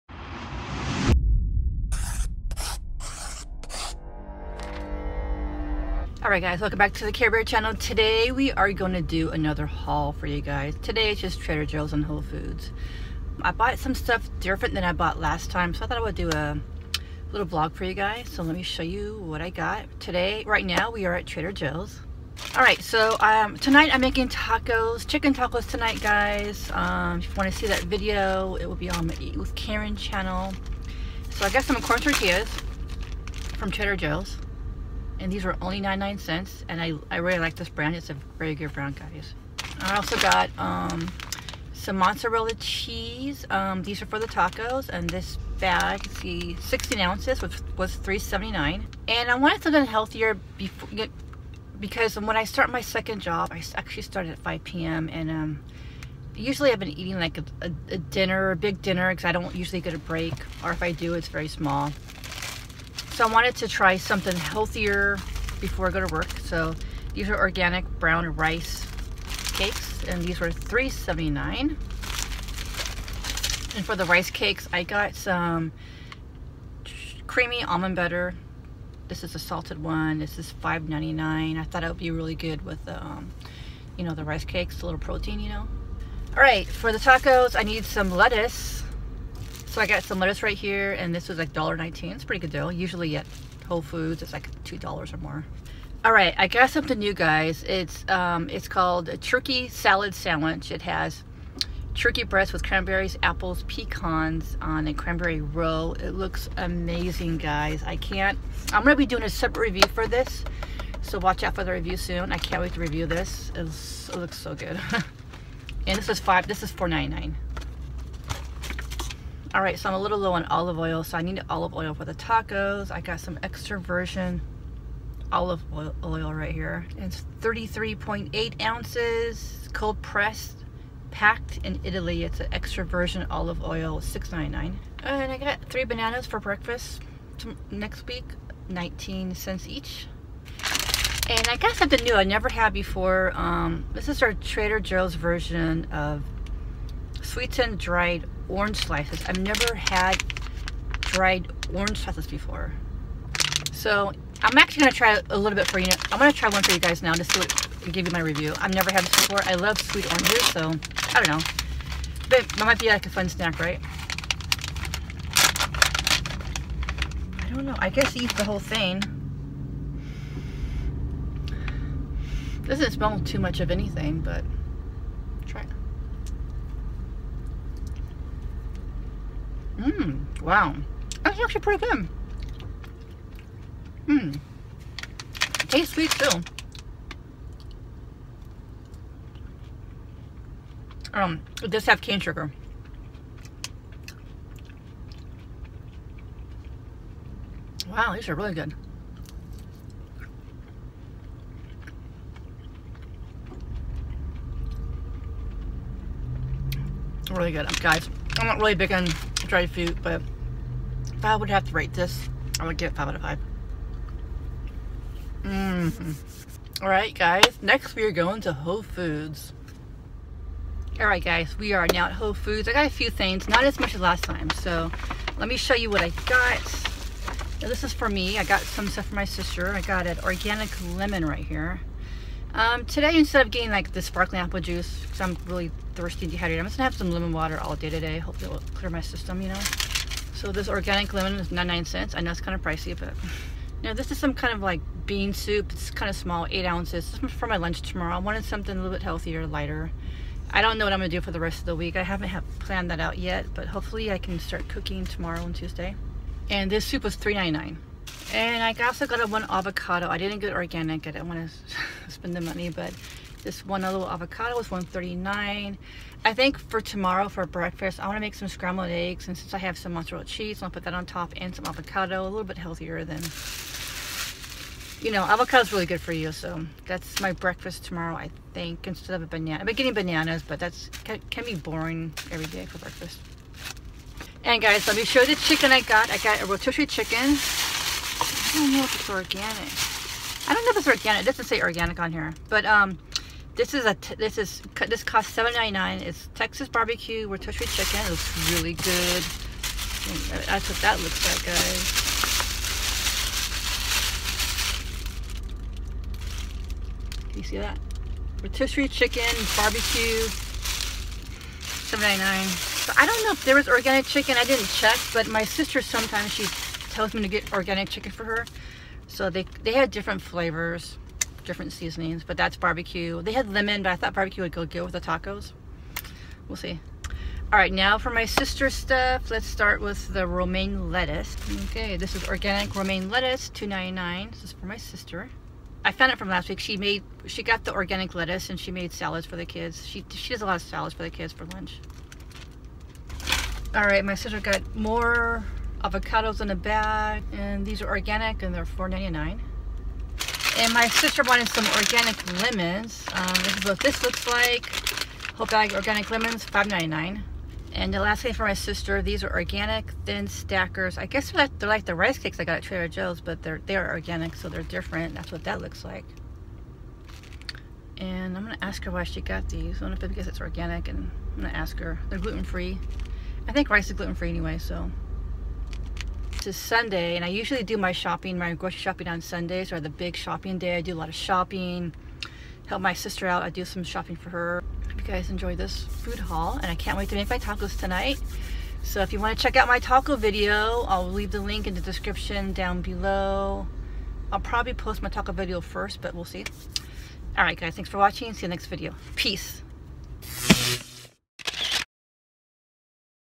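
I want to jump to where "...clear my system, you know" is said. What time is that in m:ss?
3:58.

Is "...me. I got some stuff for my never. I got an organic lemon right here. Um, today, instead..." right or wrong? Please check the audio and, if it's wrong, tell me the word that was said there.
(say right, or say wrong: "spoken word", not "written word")
wrong: "sister", not "never".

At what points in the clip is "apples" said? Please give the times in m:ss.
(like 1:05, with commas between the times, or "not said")
1:43, 3:54.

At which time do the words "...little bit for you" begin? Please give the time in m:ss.
2:35.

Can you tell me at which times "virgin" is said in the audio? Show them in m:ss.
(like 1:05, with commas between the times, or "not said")
2:03, 2:12.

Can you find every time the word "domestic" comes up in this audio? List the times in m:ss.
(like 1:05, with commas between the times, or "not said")
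not said.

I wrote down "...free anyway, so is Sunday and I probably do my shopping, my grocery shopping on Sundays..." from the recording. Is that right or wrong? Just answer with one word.
wrong.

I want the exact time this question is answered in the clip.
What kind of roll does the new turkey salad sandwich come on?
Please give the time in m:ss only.
1:44.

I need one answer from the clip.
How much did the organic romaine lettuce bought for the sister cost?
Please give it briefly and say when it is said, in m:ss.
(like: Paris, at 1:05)
$2.99, at 5:33.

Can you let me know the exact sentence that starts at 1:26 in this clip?
All right, for the tacos, I need some lettuce so I got some lettuce right here, and this was like $1.19.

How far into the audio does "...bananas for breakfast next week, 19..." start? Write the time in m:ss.
2:15.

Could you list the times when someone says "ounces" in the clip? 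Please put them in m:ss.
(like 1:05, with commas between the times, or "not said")
0:46, 2:08, 4:06.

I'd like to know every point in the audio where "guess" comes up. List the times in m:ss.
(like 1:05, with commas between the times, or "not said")
2:47, 6:01.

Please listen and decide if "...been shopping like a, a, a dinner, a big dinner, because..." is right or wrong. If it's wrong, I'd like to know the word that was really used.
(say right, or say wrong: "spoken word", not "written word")
wrong: "eating", not "shopping".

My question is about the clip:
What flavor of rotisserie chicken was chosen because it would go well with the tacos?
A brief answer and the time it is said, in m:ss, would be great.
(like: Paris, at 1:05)
Texas barbecue, at 4:56.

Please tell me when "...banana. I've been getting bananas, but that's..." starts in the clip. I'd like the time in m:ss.
4:39.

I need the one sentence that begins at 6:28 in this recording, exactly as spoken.
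So if you want to check out my taco video, I'll leave the link in the description down below.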